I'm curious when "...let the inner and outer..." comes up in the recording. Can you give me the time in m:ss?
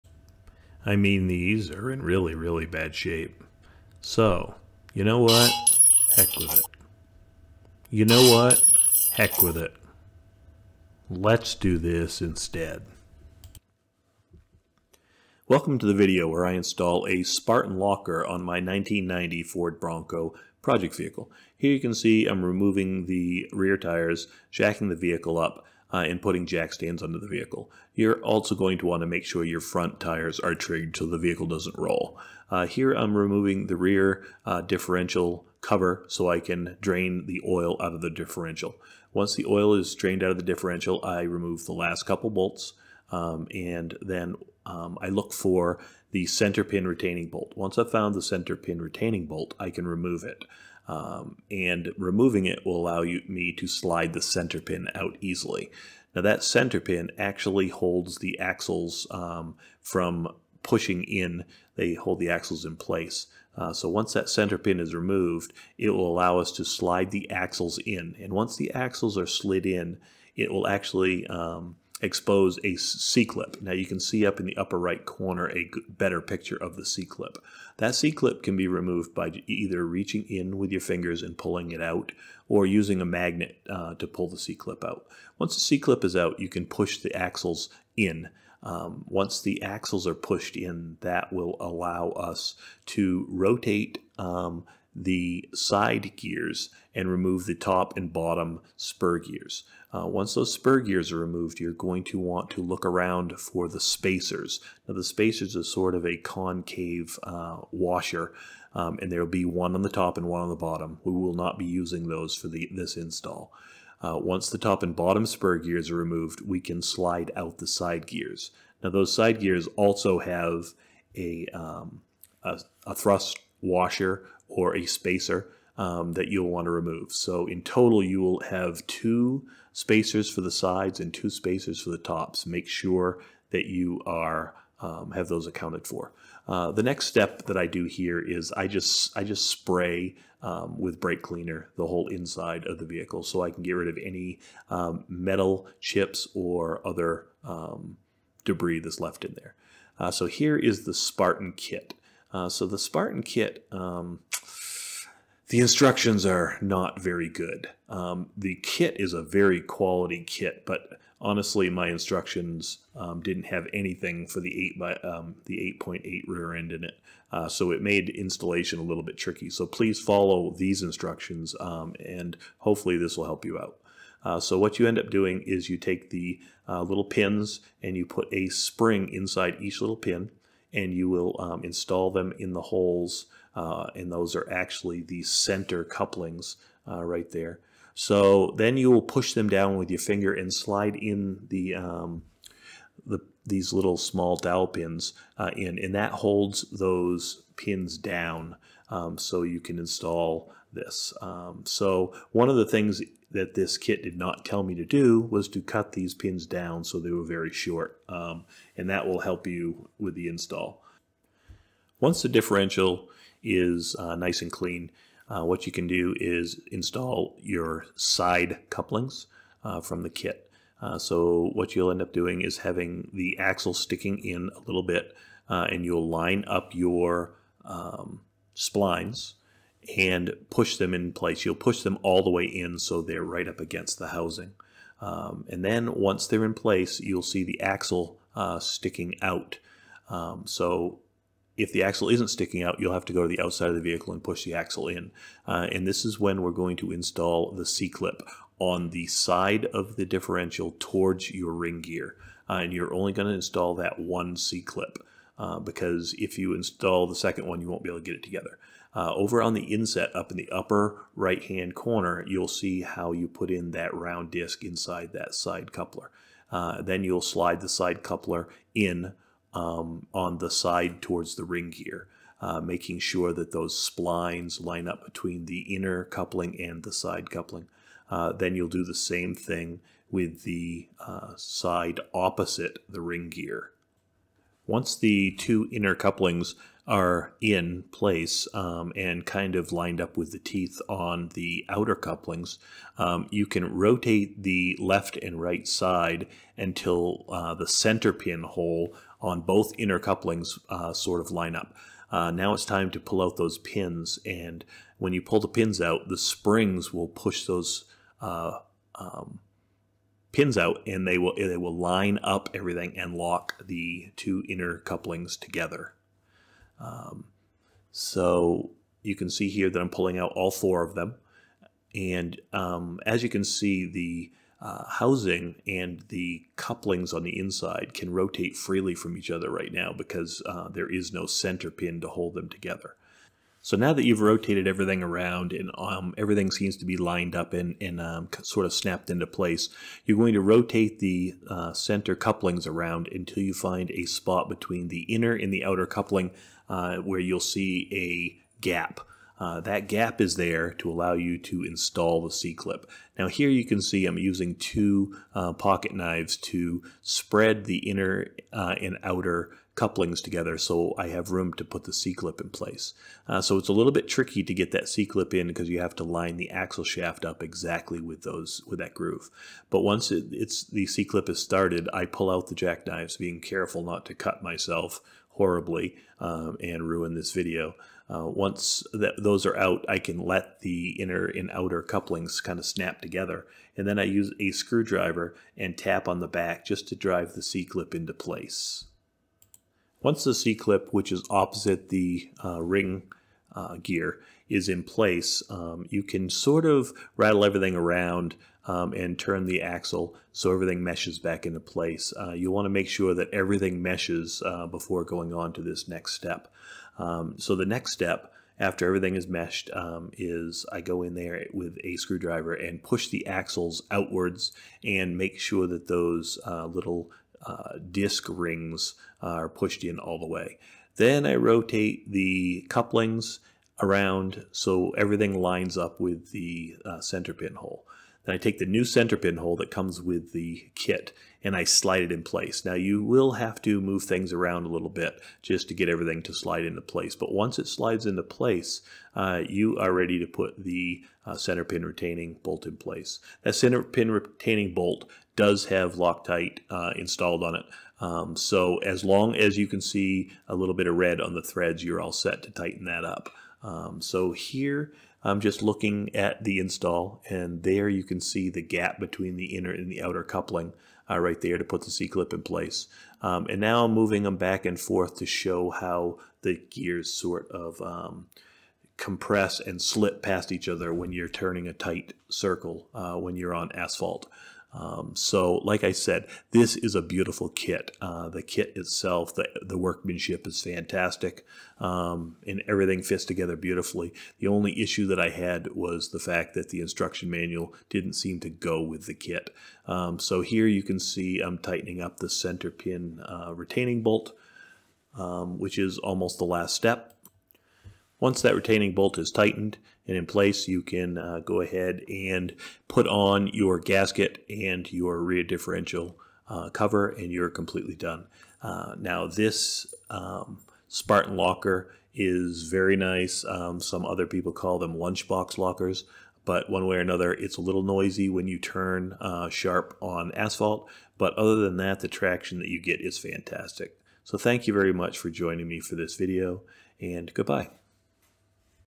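6:20.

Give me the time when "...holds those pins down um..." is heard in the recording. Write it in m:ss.
3:16.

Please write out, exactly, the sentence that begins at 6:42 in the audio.
Uh, you want to make sure that everything meshes uh, before going on to this next step.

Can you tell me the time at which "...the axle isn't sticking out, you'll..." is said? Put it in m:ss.
4:01.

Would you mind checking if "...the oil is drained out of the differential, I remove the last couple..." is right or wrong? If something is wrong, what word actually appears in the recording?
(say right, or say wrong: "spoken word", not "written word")
right.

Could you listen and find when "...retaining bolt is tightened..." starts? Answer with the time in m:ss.
8:18.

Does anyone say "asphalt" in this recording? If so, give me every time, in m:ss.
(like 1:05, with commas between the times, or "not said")
7:53, 8:40.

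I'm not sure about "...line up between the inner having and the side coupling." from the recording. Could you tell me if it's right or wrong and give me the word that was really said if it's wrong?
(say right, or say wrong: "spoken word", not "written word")
wrong: "coupling", not "having".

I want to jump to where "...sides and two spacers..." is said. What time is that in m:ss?
2:10.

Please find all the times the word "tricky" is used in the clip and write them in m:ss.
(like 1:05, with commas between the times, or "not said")
2:49, 6:04.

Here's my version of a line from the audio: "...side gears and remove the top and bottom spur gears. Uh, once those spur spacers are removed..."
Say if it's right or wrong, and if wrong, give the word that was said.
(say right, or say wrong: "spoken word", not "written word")
wrong: "gears", not "spacers".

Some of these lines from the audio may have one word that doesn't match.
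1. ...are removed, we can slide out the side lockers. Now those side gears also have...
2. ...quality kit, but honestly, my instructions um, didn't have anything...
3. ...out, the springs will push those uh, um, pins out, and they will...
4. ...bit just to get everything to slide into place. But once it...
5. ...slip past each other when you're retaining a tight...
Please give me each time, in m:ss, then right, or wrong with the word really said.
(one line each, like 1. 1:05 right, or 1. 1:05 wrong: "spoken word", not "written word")
1. 1:55 wrong: "gears", not "lockers"
2. 2:39 right
3. 5:05 right
4. 7:14 right
5. 7:49 wrong: "turning", not "retaining".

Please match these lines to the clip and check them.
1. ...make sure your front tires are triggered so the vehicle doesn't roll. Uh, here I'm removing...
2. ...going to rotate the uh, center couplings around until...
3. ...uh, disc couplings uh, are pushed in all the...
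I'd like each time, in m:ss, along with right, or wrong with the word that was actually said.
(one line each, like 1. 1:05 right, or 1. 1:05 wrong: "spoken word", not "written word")
1. 0:29 right
2. 5:40 right
3. 6:57 wrong: "rings", not "couplings".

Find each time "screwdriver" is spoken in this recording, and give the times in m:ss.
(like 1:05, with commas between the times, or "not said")
6:24, 6:51.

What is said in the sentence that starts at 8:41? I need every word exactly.
But other than that, the traction that you get is fantastic.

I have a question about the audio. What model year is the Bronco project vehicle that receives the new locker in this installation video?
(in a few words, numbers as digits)
1990.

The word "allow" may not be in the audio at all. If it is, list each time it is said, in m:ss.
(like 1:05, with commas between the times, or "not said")
0:52, 1:06, 1:31, 5:50.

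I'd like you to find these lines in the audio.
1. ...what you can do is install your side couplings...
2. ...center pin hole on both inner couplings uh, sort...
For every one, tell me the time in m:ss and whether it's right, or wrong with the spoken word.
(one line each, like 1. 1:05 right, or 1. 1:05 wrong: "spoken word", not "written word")
1. 3:35 right
2. 4:57 right.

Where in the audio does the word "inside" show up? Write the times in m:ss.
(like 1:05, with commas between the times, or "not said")
2:22, 2:59, 4:24, 5:27.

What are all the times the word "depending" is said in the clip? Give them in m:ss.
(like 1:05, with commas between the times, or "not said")
not said.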